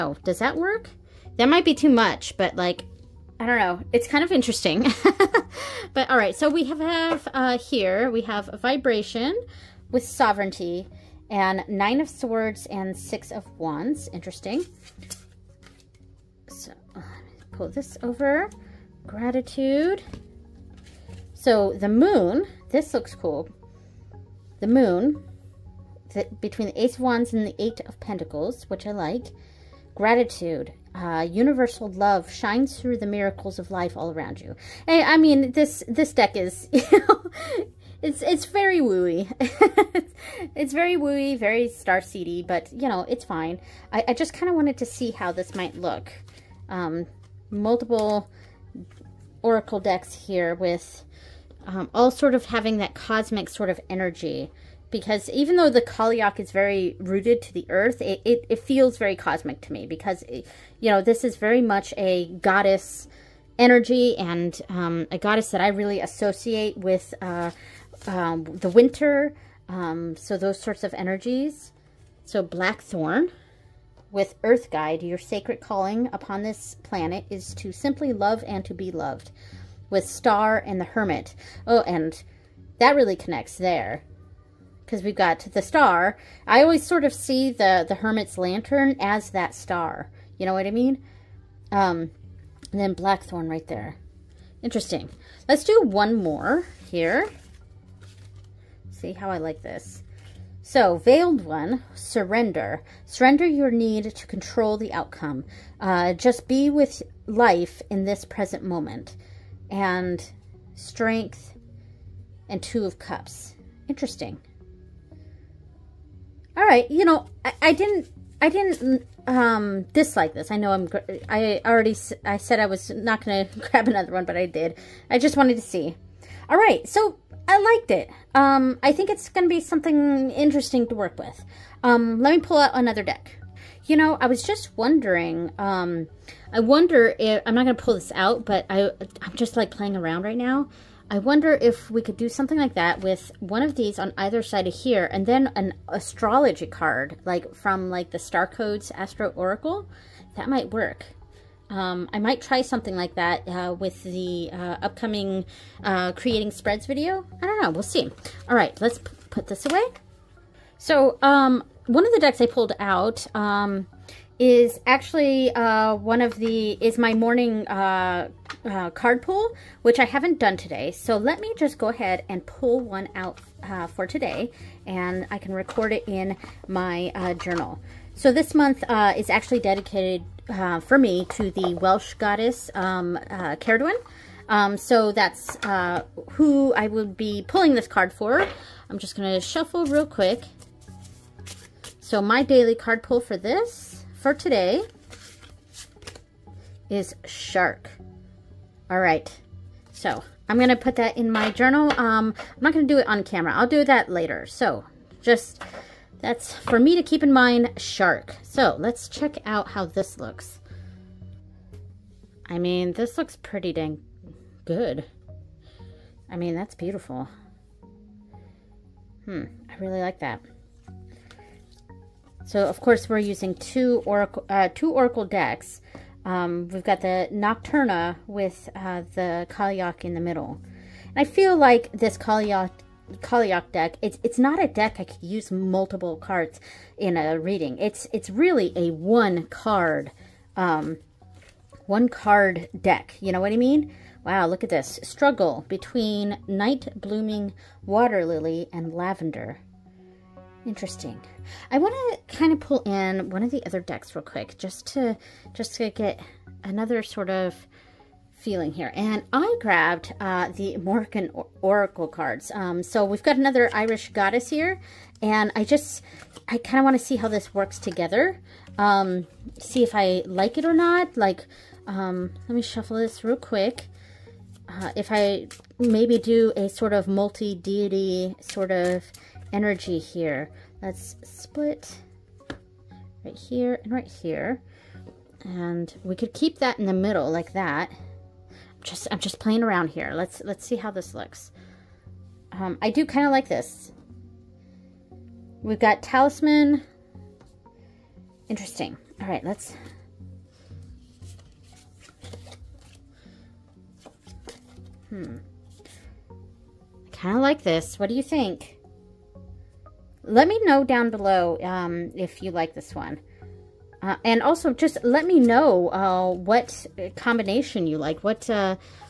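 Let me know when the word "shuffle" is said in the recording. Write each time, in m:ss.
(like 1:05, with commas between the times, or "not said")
3:09, 4:32.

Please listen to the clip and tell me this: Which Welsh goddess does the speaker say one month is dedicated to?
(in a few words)
Cerridwen.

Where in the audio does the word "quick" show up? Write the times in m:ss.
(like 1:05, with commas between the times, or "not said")
3:10, 4:14, 4:33.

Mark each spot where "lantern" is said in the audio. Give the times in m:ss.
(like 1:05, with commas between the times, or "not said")
1:28.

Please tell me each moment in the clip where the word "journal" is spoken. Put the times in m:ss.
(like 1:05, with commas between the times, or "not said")
2:57, 3:21.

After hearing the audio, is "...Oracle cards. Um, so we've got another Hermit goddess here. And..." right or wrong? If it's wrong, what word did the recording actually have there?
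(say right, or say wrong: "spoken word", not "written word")
wrong: "Irish", not "Hermit".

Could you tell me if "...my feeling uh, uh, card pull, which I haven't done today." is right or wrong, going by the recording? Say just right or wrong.
wrong.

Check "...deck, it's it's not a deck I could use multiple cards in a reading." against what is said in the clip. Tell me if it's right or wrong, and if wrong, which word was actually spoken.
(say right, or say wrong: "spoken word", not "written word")
right.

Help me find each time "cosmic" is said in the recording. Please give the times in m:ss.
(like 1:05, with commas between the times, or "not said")
0:52, 0:59.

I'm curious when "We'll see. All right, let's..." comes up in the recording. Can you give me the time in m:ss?
2:37.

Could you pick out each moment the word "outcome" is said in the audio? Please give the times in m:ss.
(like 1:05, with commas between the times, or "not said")
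1:44.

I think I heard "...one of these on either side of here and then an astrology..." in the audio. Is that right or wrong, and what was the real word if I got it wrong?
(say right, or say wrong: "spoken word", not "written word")
right.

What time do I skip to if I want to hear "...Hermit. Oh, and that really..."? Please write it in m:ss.
1:20.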